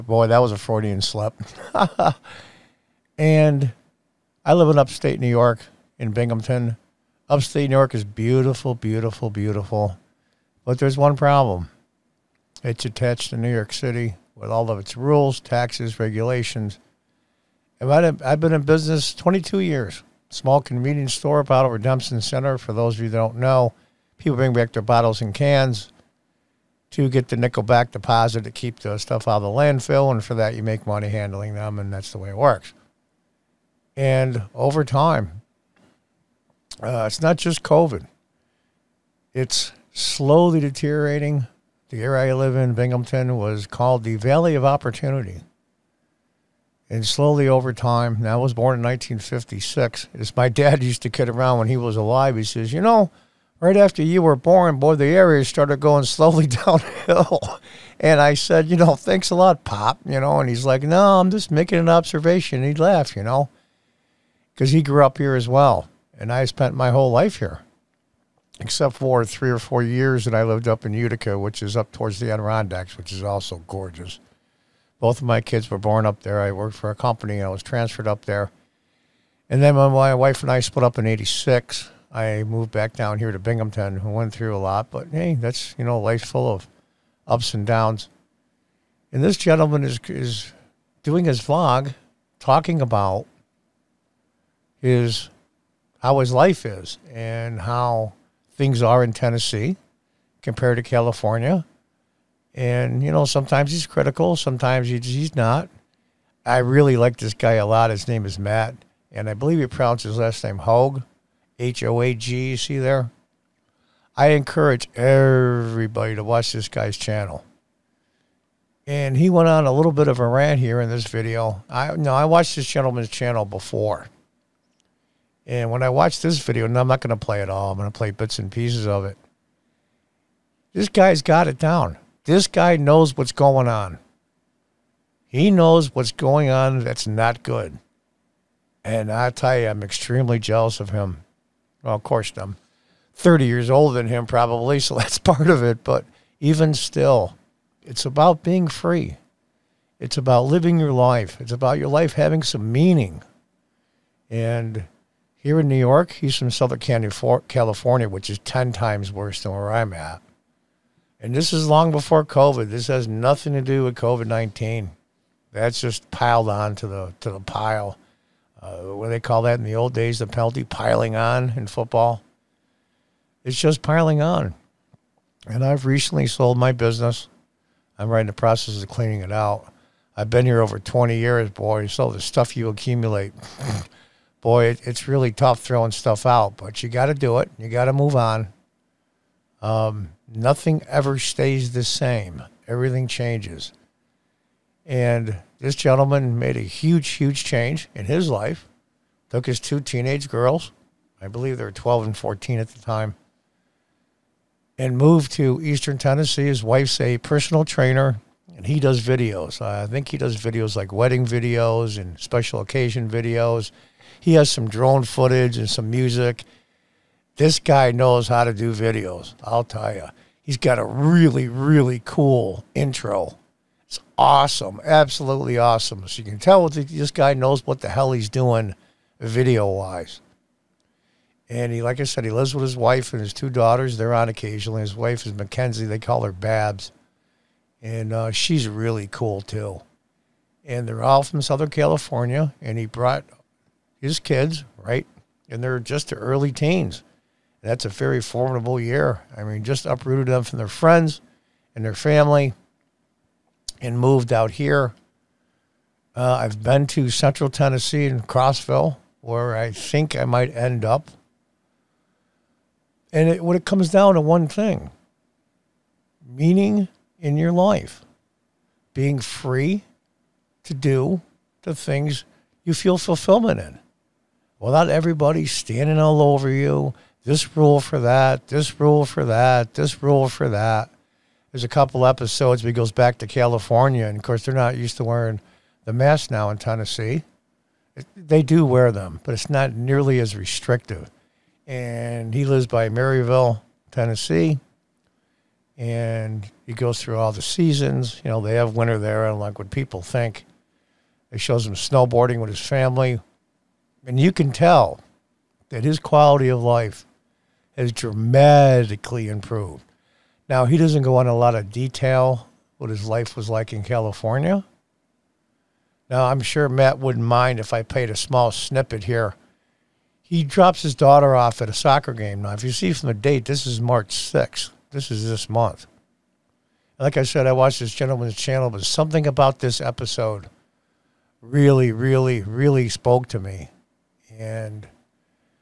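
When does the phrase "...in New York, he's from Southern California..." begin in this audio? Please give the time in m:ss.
2:35.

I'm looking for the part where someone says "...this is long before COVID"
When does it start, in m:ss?
2:41.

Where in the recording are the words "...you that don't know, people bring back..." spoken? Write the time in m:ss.
0:23.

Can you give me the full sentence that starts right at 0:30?
And for that, you make money handling them, and that's the way it works.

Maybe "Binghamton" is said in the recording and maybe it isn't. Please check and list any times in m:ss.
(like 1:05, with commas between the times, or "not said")
0:06, 0:42, 1:23.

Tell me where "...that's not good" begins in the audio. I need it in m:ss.
2:16.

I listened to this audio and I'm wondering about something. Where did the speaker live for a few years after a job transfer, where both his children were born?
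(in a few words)
Utica.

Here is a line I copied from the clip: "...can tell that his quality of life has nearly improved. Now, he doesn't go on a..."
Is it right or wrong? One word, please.
wrong.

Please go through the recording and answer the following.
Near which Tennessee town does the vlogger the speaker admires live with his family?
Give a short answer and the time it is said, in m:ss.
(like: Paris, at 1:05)
Maryville, at 4:52.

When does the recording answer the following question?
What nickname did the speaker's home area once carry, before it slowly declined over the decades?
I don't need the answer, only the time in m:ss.
0:44.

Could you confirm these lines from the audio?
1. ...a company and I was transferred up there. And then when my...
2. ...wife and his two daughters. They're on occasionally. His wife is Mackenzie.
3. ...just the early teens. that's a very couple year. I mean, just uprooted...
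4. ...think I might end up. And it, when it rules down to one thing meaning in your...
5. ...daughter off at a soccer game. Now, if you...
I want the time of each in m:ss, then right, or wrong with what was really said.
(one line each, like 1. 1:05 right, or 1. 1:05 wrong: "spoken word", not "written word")
1. 1:16 right
2. 3:52 right
3. 4:05 wrong: "formidable", not "couple"
4. 4:19 wrong: "comes", not "rules"
5. 5:20 right.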